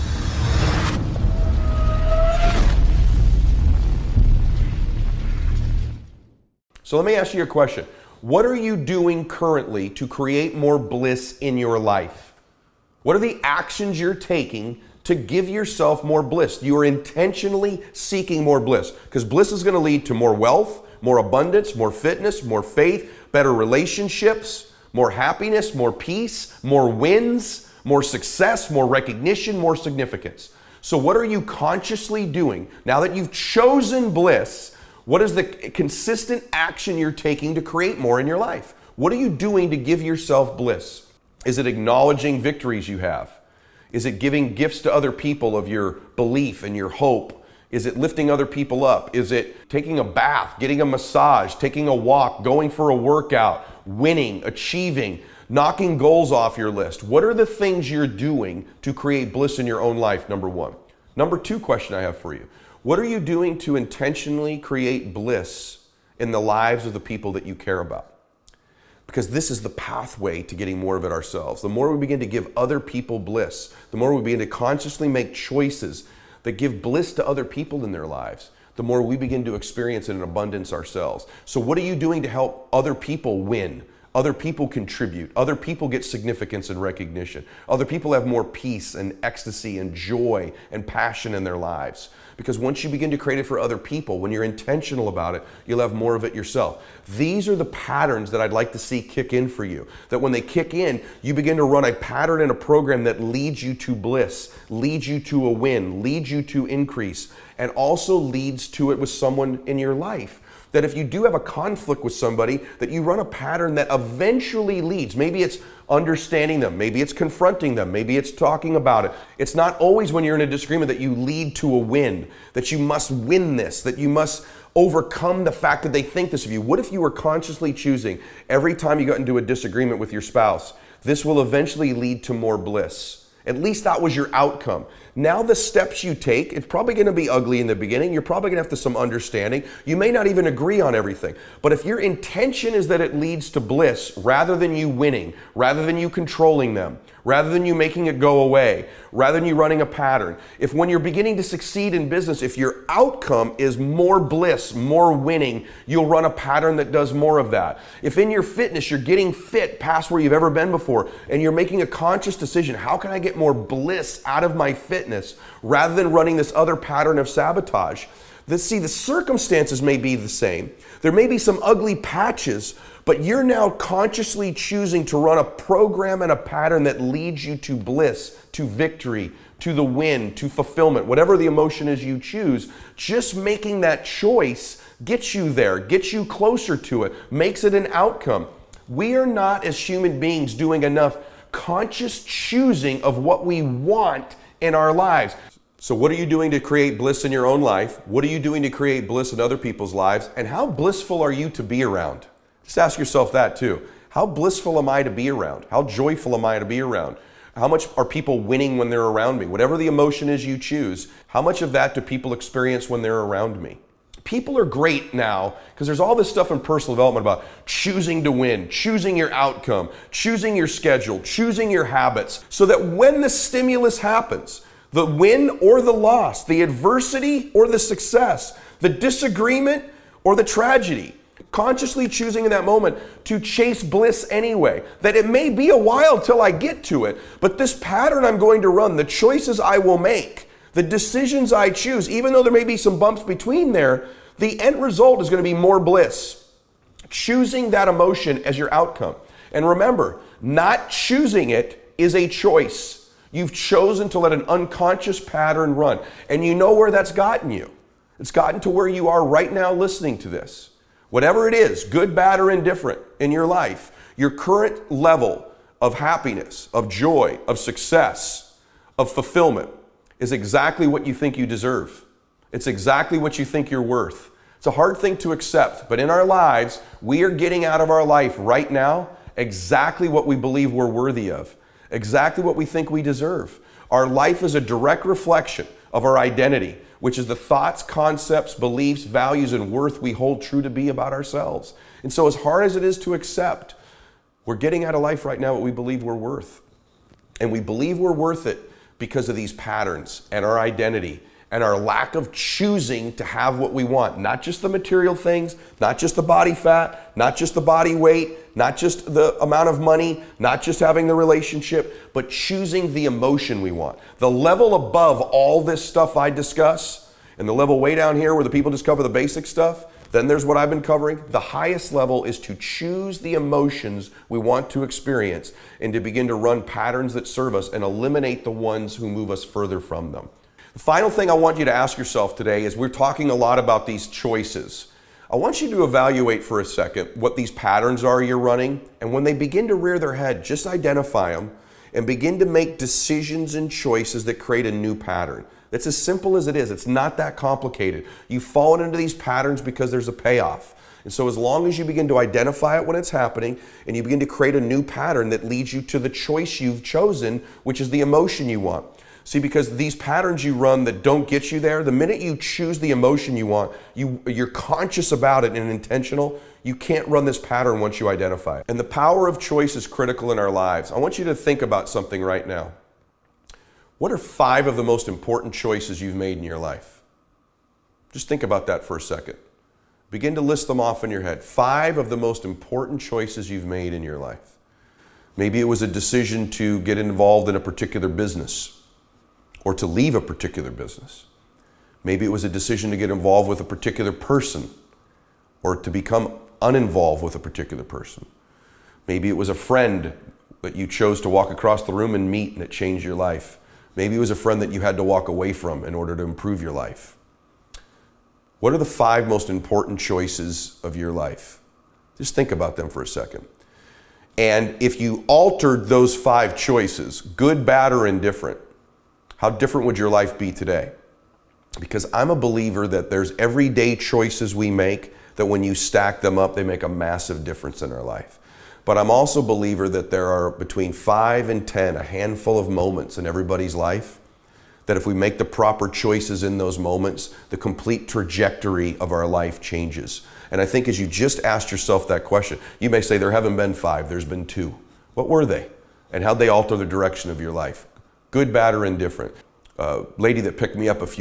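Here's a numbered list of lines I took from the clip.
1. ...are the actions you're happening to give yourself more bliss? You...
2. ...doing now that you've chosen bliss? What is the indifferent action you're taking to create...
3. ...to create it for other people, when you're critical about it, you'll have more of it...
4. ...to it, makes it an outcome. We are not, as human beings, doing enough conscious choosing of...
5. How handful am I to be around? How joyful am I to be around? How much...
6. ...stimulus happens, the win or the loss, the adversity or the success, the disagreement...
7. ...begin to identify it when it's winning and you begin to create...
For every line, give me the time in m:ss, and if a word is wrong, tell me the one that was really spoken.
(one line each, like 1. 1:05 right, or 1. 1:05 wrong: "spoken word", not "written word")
1. 0:13 wrong: "taking", not "happening"
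2. 0:32 wrong: "consistent", not "indifferent"
3. 1:33 wrong: "intentional", not "critical"
4. 3:06 right
5. 3:24 wrong: "blissful", not "handful"
6. 3:43 right
7. 5:51 wrong: "happening", not "winning".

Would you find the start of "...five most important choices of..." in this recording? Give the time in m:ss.
6:48.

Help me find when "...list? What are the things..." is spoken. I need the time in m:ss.
0:56.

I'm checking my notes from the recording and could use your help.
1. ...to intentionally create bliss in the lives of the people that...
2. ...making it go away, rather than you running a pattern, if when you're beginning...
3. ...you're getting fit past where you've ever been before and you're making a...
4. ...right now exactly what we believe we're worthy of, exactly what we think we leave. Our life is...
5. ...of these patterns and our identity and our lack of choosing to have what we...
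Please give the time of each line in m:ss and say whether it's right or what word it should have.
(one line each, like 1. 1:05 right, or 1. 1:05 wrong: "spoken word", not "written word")
1. 1:03 right
2. 2:27 right
3. 2:38 right
4. 4:38 wrong: "deserve", not "leave"
5. 4:59 right.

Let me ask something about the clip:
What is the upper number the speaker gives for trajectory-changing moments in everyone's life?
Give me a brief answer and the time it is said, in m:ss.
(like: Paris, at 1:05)
10, at 7:11.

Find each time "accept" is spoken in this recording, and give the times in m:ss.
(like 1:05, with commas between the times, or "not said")
4:35, 4:53.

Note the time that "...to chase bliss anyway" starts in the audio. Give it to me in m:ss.
3:53.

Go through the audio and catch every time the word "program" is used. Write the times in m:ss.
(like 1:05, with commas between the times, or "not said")
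1:42, 2:55.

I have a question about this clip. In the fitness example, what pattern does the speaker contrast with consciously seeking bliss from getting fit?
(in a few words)
sabotage.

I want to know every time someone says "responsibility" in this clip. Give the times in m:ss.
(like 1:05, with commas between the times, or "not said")
not said.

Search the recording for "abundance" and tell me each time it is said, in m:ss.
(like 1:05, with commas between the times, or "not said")
0:21, 1:20.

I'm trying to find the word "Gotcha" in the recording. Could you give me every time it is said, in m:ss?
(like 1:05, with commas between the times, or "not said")
not said.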